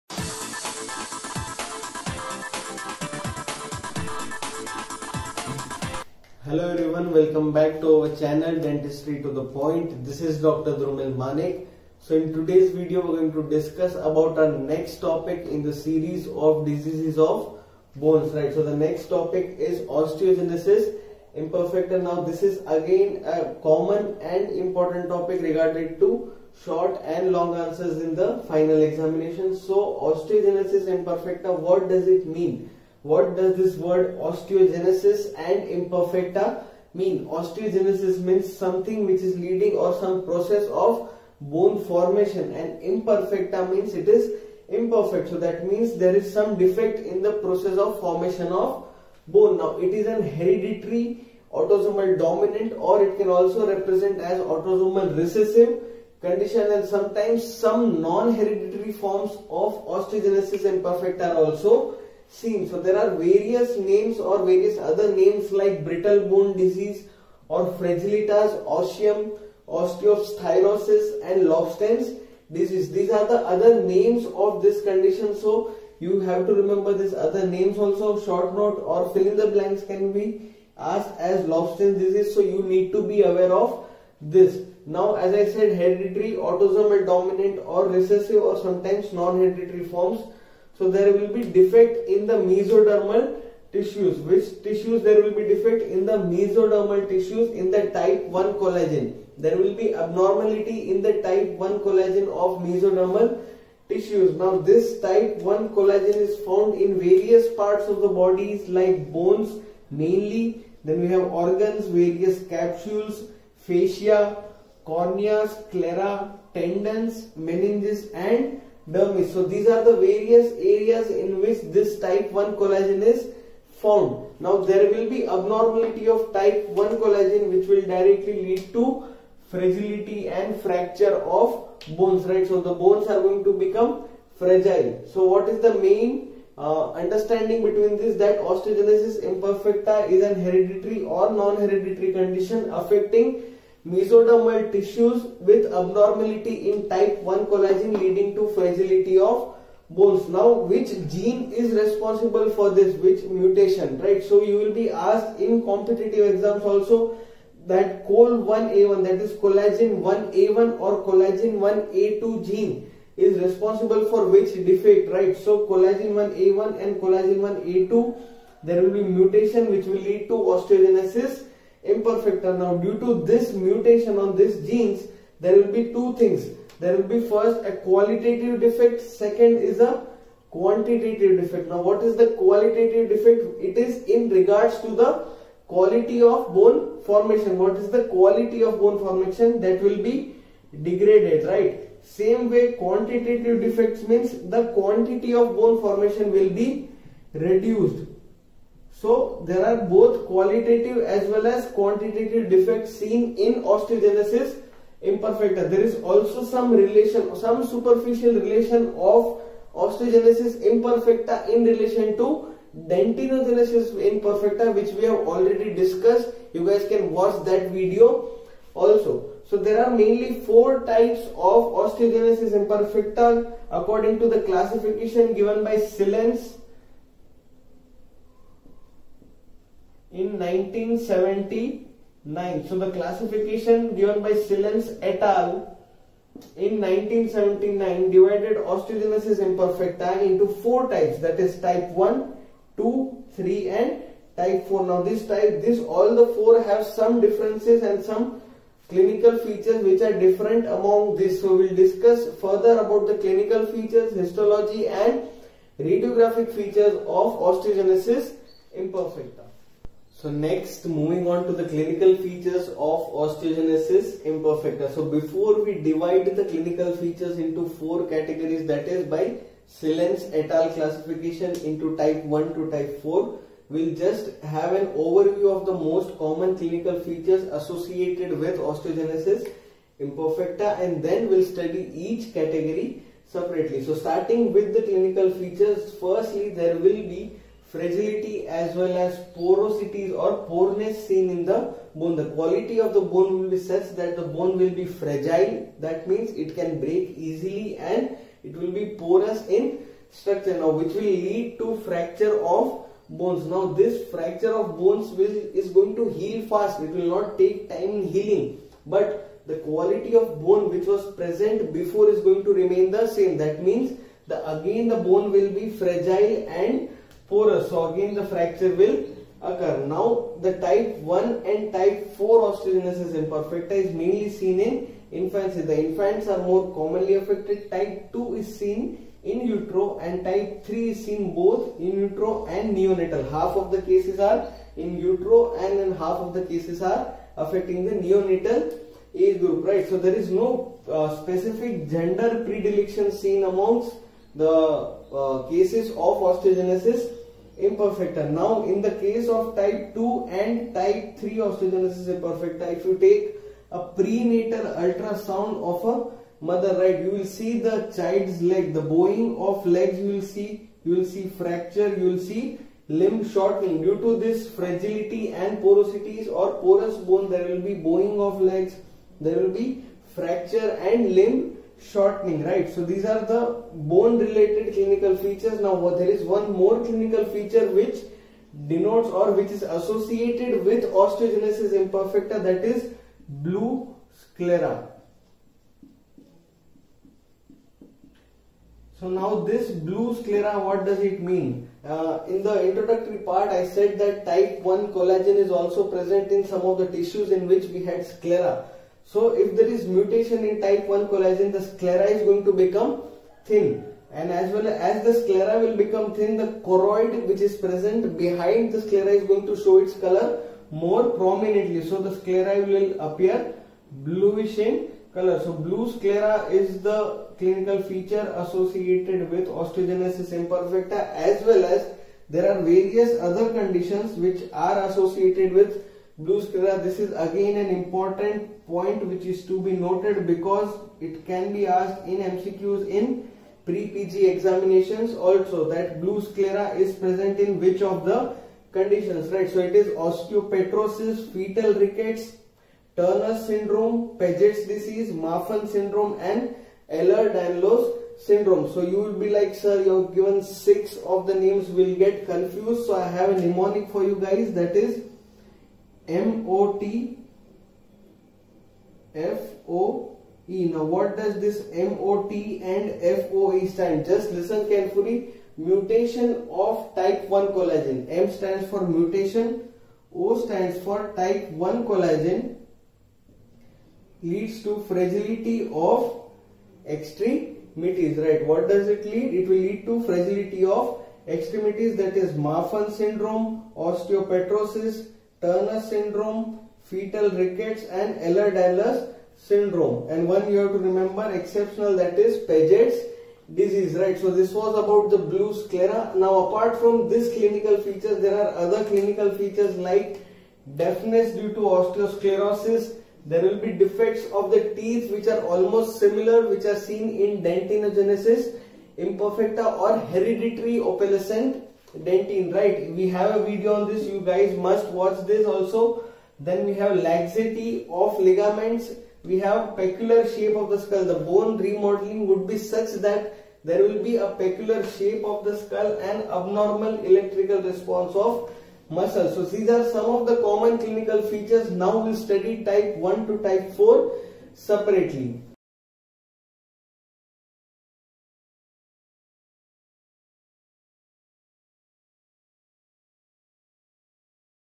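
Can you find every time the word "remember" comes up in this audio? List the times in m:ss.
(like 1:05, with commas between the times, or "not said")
1:16, 8:10.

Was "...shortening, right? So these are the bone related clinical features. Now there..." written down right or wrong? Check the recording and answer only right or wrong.
right.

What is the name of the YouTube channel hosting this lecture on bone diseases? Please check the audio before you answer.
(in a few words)
Dentistry to the Point.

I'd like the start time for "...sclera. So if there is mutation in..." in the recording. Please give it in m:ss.
6:38.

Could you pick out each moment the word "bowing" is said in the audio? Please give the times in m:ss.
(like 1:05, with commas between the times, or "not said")
5:58, 6:07.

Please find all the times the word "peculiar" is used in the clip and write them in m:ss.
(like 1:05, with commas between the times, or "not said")
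8:39, 8:44.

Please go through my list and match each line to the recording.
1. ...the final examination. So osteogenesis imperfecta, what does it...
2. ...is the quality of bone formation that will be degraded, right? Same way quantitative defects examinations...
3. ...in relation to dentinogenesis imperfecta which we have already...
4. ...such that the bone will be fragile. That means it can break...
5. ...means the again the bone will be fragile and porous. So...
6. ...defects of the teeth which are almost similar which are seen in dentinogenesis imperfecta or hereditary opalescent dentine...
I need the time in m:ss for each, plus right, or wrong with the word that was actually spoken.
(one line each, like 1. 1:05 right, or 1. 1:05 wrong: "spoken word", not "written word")
1. 0:28 right
2. 3:07 wrong: "means", not "examinations"
3. 3:31 right
4. 4:53 right
5. 5:13 right
6. 8:23 right.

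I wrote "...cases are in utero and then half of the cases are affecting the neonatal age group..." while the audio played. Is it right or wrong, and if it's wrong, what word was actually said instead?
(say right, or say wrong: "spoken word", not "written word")
right.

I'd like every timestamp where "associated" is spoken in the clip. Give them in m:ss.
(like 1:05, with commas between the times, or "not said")
4:37, 6:19, 6:58, 7:04.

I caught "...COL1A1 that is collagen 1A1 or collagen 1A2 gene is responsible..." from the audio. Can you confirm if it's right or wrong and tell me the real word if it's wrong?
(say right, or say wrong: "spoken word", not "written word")
right.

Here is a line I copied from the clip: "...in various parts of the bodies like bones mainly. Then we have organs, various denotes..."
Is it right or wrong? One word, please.
wrong.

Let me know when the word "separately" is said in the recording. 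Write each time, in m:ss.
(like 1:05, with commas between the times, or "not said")
4:43, 8:54.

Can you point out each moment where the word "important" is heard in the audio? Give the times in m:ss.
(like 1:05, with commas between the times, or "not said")
0:24, 7:07.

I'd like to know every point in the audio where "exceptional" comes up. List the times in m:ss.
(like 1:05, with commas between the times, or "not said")
8:11.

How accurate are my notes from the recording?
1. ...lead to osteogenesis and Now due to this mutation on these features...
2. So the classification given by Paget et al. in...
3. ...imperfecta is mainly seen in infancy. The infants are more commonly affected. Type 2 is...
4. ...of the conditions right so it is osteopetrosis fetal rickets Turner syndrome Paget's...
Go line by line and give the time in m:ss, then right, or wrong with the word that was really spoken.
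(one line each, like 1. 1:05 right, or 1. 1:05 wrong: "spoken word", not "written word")
1. 2:50 wrong: "genes", not "features"
2. 3:52 wrong: "Sillence", not "Paget"
3. 5:23 right
4. 7:17 right.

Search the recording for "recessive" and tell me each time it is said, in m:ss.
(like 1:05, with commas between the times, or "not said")
0:55, 1:27.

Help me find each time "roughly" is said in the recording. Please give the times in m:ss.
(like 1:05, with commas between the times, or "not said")
not said.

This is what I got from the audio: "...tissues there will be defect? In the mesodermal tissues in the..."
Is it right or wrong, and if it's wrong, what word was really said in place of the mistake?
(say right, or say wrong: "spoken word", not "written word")
right.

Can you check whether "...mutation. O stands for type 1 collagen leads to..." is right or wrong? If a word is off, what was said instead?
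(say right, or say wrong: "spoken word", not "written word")
right.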